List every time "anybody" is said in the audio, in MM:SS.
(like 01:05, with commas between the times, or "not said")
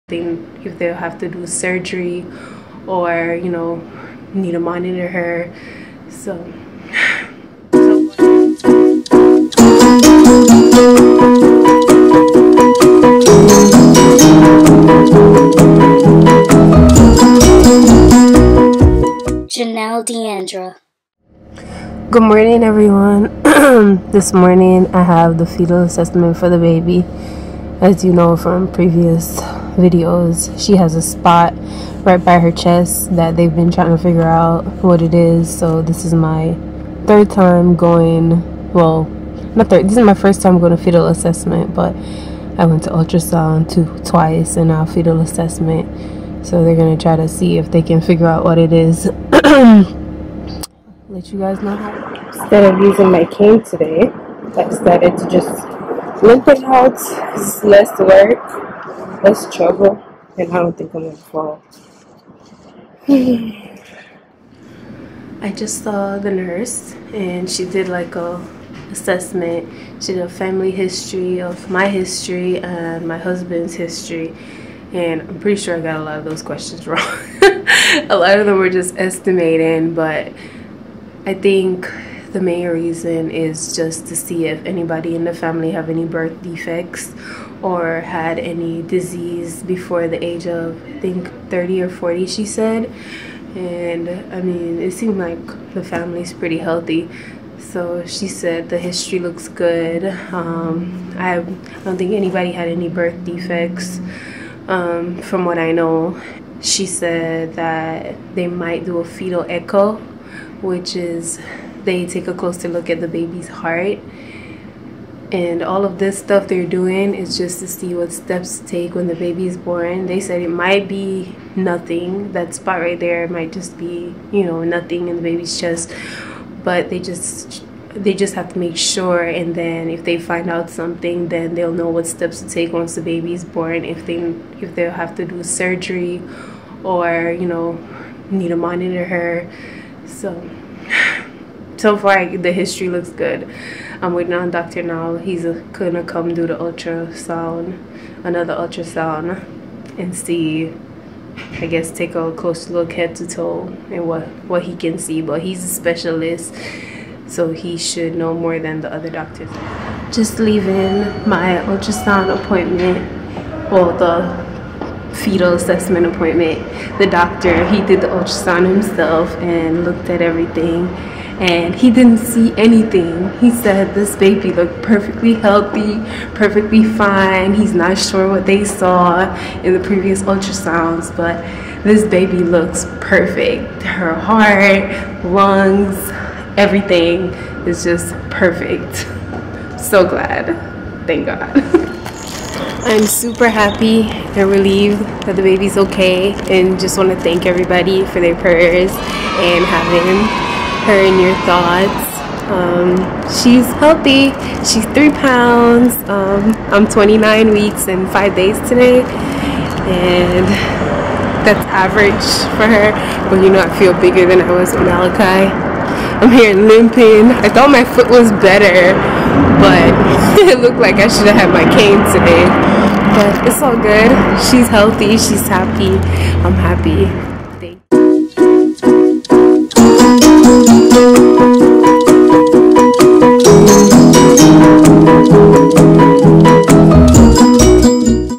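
01:24, 01:42.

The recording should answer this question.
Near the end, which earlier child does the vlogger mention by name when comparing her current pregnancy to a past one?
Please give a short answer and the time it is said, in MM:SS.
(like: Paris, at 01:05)
Malachi, at 03:34.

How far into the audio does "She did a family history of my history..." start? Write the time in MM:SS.
01:10.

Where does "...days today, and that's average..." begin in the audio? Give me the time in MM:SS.
03:28.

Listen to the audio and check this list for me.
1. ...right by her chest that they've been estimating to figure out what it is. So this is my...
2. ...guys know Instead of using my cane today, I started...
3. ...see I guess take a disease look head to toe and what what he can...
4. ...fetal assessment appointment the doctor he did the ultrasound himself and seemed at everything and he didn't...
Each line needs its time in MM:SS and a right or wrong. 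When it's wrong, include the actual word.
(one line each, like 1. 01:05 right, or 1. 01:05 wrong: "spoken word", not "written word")
1. 00:32 wrong: "trying", not "estimating"
2. 00:51 right
3. 02:30 wrong: "close", not "disease"
4. 02:45 wrong: "looked", not "seemed".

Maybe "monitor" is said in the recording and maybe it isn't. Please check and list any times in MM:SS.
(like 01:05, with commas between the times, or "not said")
00:04, 02:18.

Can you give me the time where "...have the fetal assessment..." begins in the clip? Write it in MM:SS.
00:25.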